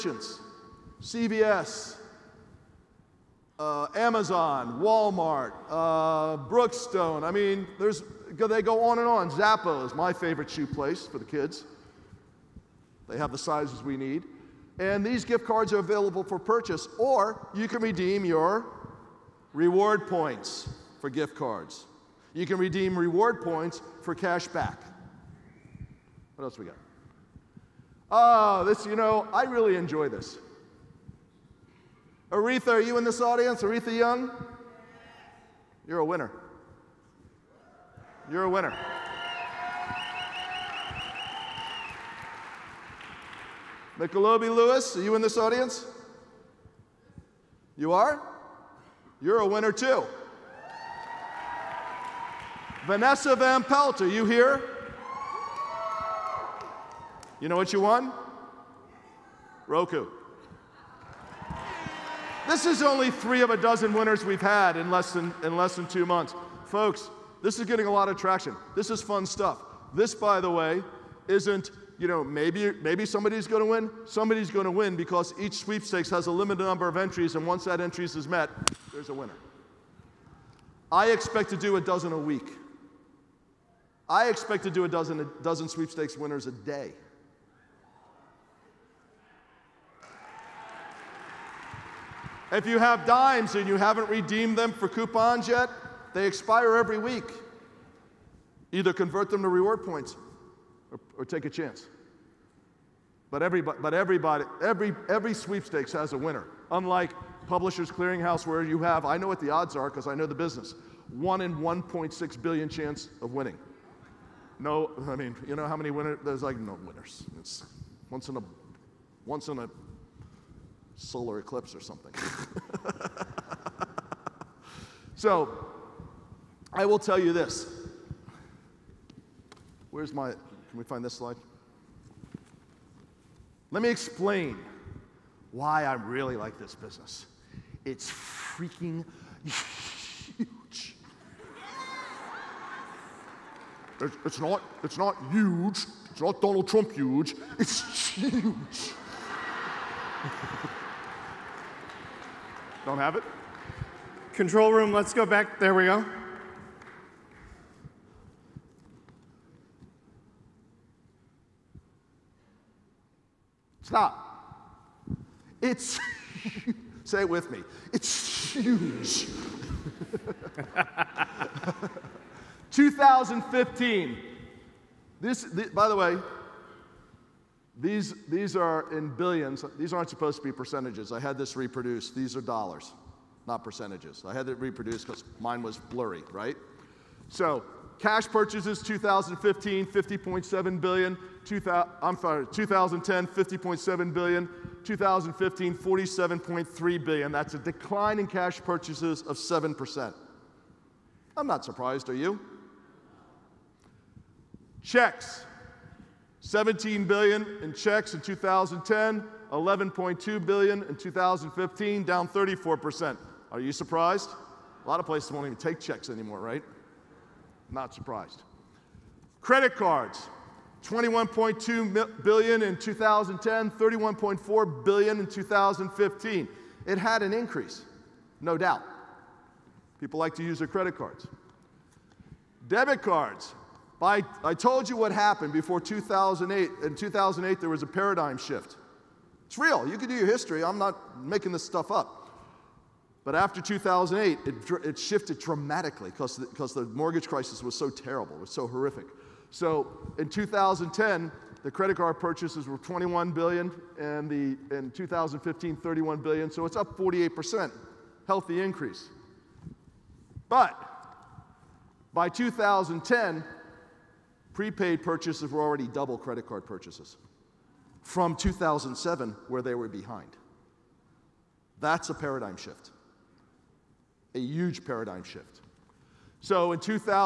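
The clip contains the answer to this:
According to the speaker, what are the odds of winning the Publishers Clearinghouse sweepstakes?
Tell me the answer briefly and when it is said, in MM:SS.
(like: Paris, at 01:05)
1 in 1.6 billion, at 01:51.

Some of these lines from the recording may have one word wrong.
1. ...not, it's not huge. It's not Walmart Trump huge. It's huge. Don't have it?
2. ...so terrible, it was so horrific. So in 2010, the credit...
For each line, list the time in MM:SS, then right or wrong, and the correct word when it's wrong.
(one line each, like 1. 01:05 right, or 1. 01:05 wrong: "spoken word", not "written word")
1. 02:24 wrong: "Donald", not "Walmart"
2. 04:07 right.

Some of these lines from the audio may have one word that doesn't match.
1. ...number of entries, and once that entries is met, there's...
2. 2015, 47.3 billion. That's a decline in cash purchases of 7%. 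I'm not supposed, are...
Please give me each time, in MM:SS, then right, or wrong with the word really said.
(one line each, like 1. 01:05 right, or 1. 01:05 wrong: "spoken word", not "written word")
1. 01:16 right
2. 03:14 wrong: "surprised", not "supposed".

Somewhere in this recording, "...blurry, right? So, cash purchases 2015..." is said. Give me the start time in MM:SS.
03:05.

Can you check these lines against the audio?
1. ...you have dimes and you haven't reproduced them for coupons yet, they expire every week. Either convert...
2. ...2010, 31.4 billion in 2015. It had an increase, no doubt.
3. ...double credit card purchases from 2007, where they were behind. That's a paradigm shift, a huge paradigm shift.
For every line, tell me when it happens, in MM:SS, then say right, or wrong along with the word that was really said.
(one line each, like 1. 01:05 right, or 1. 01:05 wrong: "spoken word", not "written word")
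1. 01:32 wrong: "redeemed", not "reproduced"
2. 03:42 right
3. 04:25 right.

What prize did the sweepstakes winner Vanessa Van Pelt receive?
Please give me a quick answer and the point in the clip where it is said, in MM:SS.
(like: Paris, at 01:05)
Roku, at 00:59.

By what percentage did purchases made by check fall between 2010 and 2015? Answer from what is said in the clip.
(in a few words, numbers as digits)
34%.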